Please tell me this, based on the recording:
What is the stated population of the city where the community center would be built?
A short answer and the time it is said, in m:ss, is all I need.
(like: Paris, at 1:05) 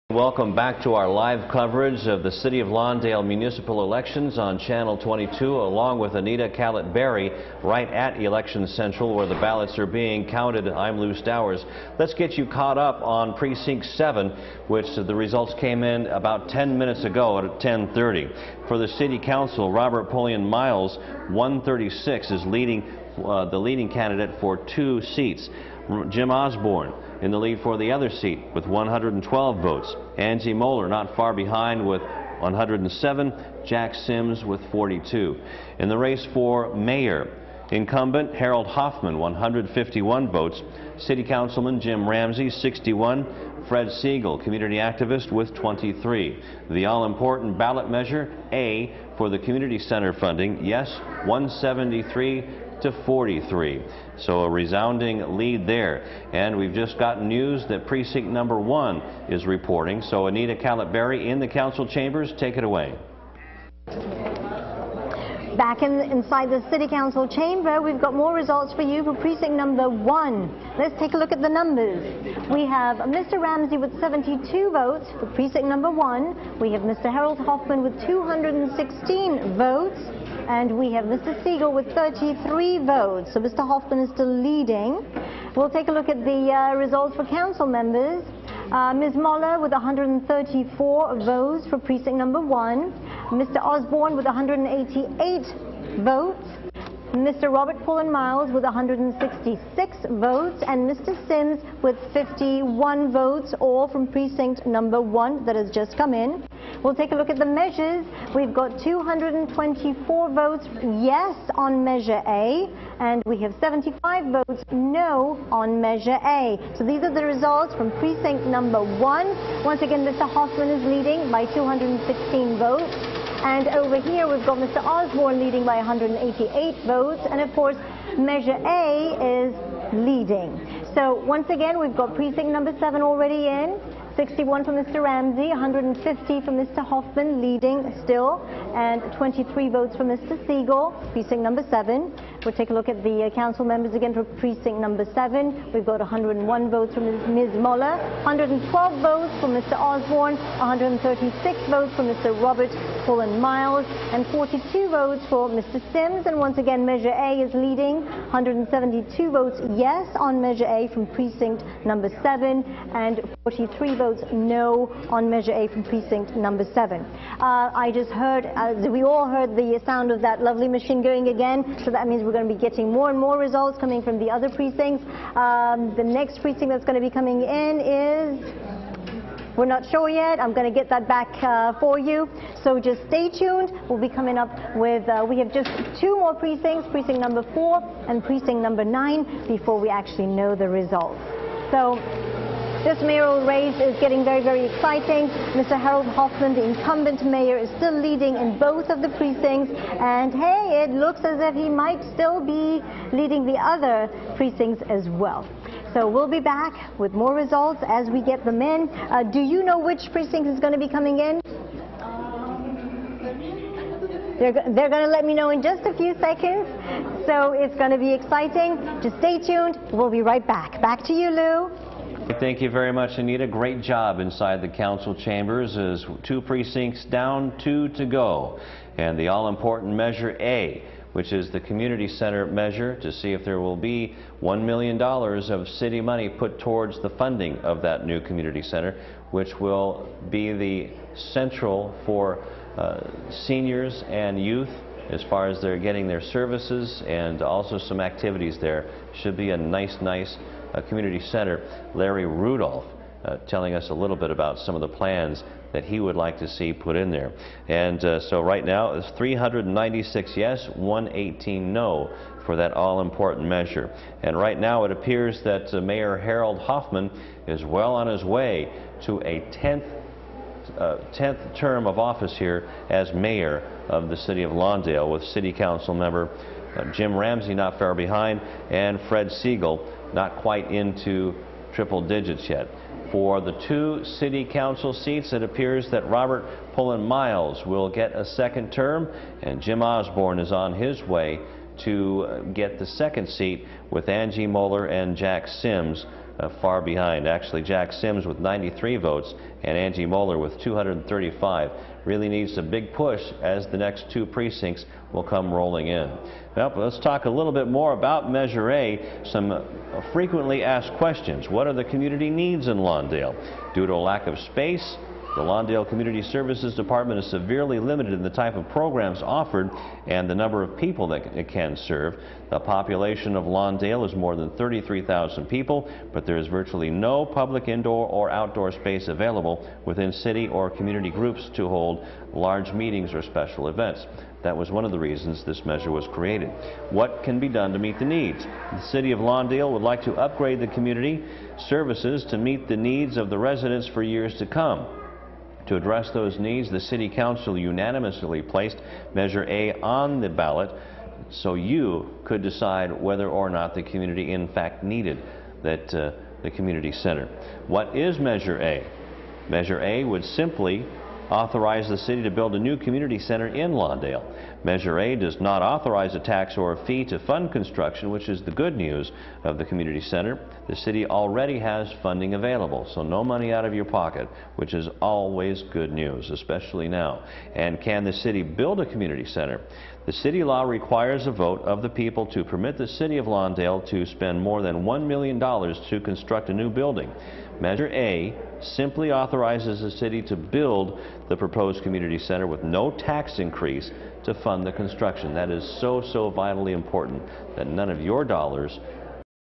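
more than 33,000, at 5:24.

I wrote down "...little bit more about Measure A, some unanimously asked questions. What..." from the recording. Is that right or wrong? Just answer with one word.
wrong.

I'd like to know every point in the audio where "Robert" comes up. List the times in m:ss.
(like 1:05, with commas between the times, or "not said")
0:19, 1:37, 2:32, 4:46.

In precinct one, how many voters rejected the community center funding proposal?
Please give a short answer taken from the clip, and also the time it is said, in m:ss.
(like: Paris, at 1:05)
75, at 1:53.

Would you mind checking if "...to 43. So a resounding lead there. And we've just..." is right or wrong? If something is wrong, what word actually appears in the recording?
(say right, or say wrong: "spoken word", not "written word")
right.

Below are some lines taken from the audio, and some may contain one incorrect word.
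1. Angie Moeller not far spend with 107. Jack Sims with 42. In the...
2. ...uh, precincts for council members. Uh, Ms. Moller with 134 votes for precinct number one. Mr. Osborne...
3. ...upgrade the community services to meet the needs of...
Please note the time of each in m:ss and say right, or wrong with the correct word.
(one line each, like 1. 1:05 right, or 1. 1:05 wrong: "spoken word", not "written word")
1. 0:30 wrong: "behind", not "spend"
2. 1:26 wrong: "results", not "precincts"
3. 5:40 right.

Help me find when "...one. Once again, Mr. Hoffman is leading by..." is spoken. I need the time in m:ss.
1:58.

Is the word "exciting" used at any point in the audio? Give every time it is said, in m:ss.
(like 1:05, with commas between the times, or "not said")
3:14, 3:38.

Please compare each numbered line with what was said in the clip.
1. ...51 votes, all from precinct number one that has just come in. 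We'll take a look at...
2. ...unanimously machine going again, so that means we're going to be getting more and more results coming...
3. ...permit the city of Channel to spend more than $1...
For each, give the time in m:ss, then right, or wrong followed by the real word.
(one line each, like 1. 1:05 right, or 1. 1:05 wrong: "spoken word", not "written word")
1. 1:42 right
2. 2:50 wrong: "lovely", not "unanimously"
3. 6:22 wrong: "Lawndale", not "Channel".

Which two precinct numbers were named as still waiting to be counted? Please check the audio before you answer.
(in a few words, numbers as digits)
4 and 9.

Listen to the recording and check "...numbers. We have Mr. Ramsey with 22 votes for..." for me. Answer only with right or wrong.
wrong.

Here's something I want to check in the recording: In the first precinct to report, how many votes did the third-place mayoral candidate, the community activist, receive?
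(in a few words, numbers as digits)
23.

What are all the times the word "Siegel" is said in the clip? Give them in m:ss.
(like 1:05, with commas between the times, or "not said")
0:43, 1:21, 2:20, 4:39.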